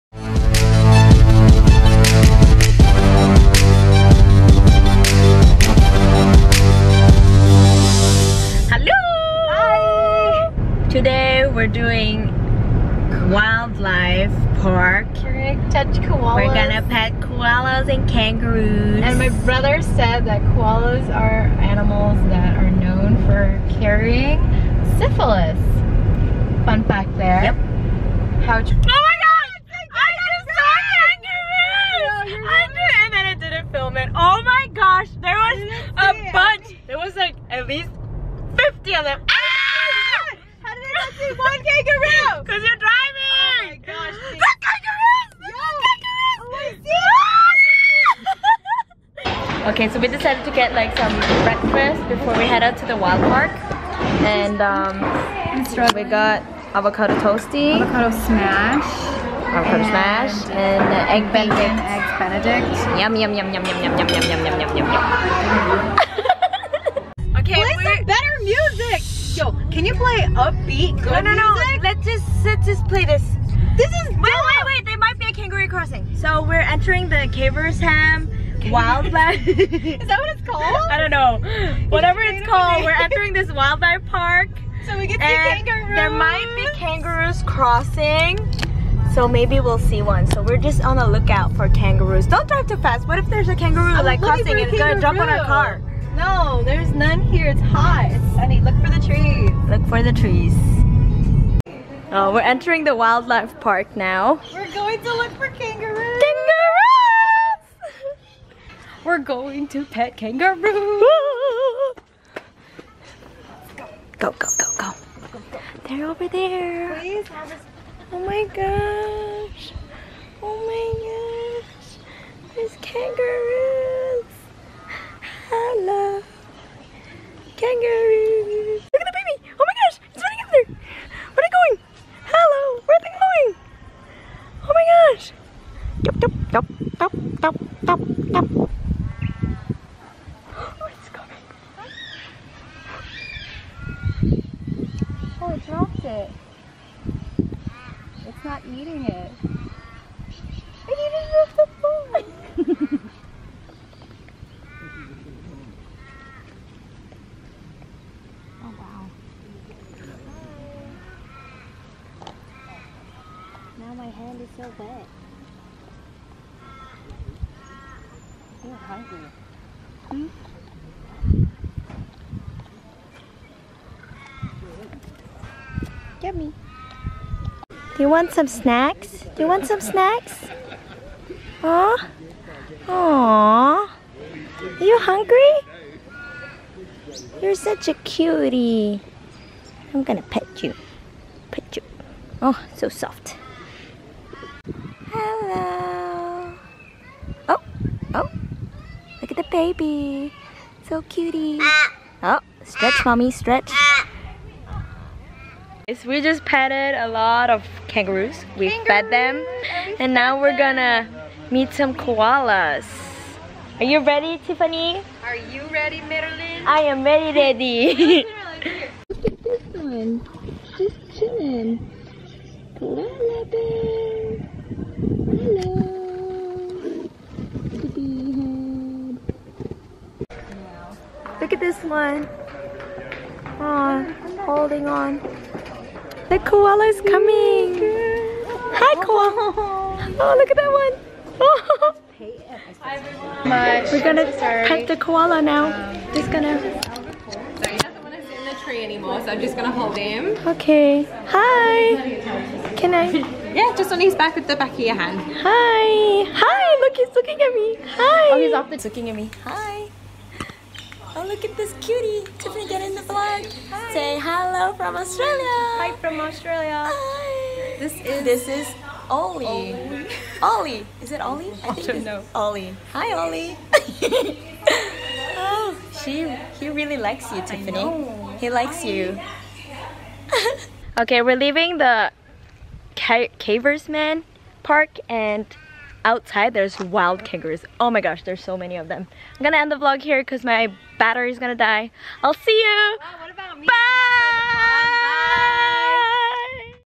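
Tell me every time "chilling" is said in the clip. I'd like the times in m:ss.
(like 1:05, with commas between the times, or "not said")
3:41.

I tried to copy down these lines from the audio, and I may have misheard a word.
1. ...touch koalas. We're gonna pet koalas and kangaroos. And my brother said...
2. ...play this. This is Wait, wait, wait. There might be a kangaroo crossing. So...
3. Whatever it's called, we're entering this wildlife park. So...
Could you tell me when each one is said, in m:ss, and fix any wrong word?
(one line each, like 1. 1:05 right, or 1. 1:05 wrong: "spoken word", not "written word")
1. 0:15 right
2. 1:12 right
3. 1:21 right.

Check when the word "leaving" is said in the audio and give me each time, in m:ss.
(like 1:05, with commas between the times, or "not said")
4:41.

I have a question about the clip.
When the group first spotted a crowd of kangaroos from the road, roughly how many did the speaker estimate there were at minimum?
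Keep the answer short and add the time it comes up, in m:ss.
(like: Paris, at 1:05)
50, at 0:38.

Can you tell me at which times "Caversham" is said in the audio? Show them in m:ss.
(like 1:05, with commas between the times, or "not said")
1:17, 4:43.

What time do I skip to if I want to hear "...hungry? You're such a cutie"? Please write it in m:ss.
3:04.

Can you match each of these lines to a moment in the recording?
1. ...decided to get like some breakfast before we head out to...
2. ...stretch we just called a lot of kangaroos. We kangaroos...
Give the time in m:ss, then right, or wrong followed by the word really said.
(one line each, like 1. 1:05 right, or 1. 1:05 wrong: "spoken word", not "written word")
1. 0:50 right
2. 3:23 wrong: "petted", not "called".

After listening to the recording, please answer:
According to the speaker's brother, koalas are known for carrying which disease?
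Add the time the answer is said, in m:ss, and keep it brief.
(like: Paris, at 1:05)
syphilis, at 0:24.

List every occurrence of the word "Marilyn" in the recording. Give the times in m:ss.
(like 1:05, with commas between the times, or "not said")
3:36.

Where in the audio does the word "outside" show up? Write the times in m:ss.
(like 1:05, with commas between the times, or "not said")
4:46.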